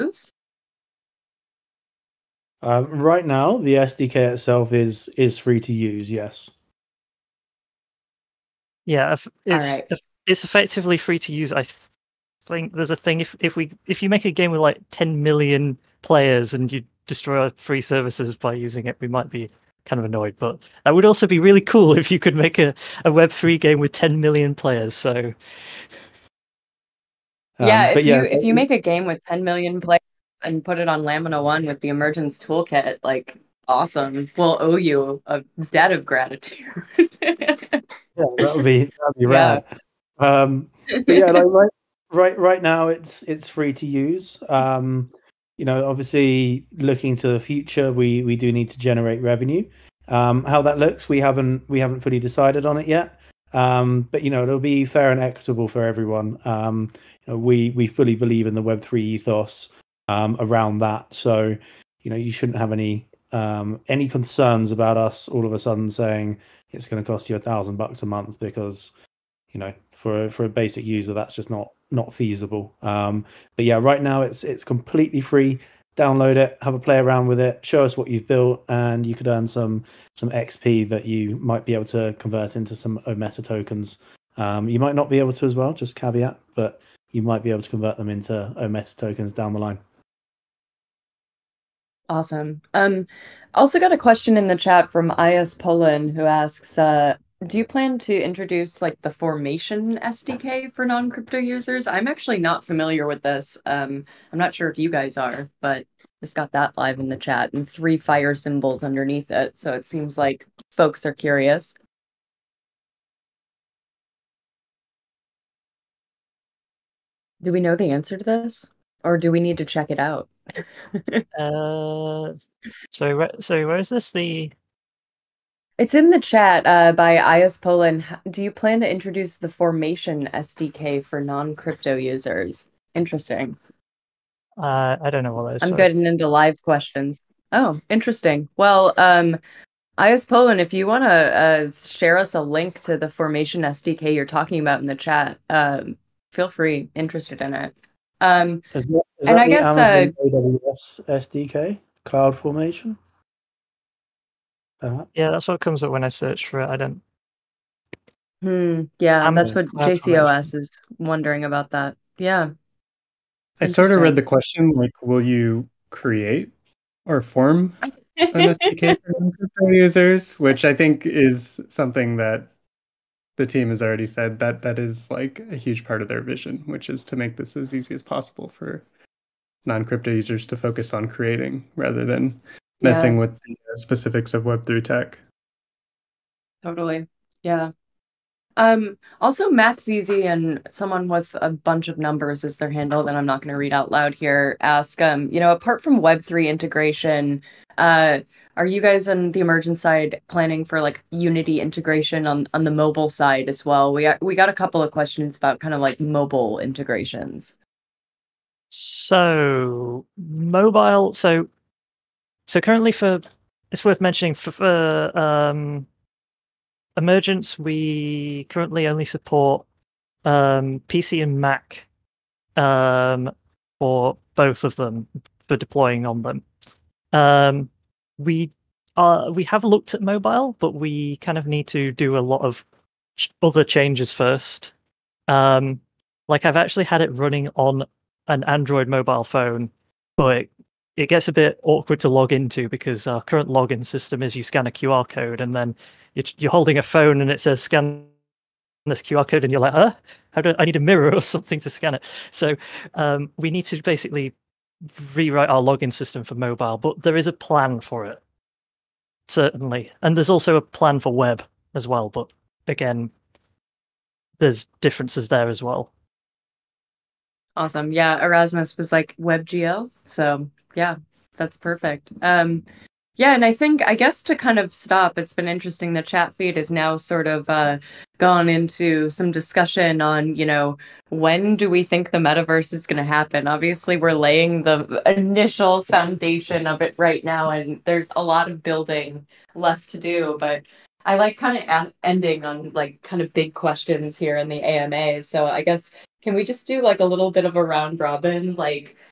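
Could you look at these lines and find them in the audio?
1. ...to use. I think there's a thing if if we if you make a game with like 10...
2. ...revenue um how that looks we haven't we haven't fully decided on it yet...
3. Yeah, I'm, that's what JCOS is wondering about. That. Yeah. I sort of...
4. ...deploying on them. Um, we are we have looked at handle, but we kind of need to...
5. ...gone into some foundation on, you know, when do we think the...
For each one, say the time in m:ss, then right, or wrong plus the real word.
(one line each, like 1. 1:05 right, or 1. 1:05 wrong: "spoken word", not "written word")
1. 0:11 right
2. 0:49 right
3. 2:38 right
4. 3:45 wrong: "mobile", not "handle"
5. 4:38 wrong: "discussion", not "foundation".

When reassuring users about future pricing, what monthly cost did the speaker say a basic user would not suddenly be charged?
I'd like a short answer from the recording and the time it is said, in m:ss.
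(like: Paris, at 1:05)
a thousand bucks, at 1:07.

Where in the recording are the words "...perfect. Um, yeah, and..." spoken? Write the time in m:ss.
4:31.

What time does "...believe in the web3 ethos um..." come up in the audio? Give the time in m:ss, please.
0:58.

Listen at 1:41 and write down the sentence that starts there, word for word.
I'm actually not familiar with this.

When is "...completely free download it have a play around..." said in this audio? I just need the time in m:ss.
1:14.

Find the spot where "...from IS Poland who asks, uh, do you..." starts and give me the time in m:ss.
1:34.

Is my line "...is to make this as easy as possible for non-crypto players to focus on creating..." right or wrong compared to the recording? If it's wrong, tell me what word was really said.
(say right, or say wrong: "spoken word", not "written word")
wrong: "users", not "players".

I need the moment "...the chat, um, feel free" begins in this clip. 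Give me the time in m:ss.
2:24.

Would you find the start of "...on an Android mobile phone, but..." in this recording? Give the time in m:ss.
3:57.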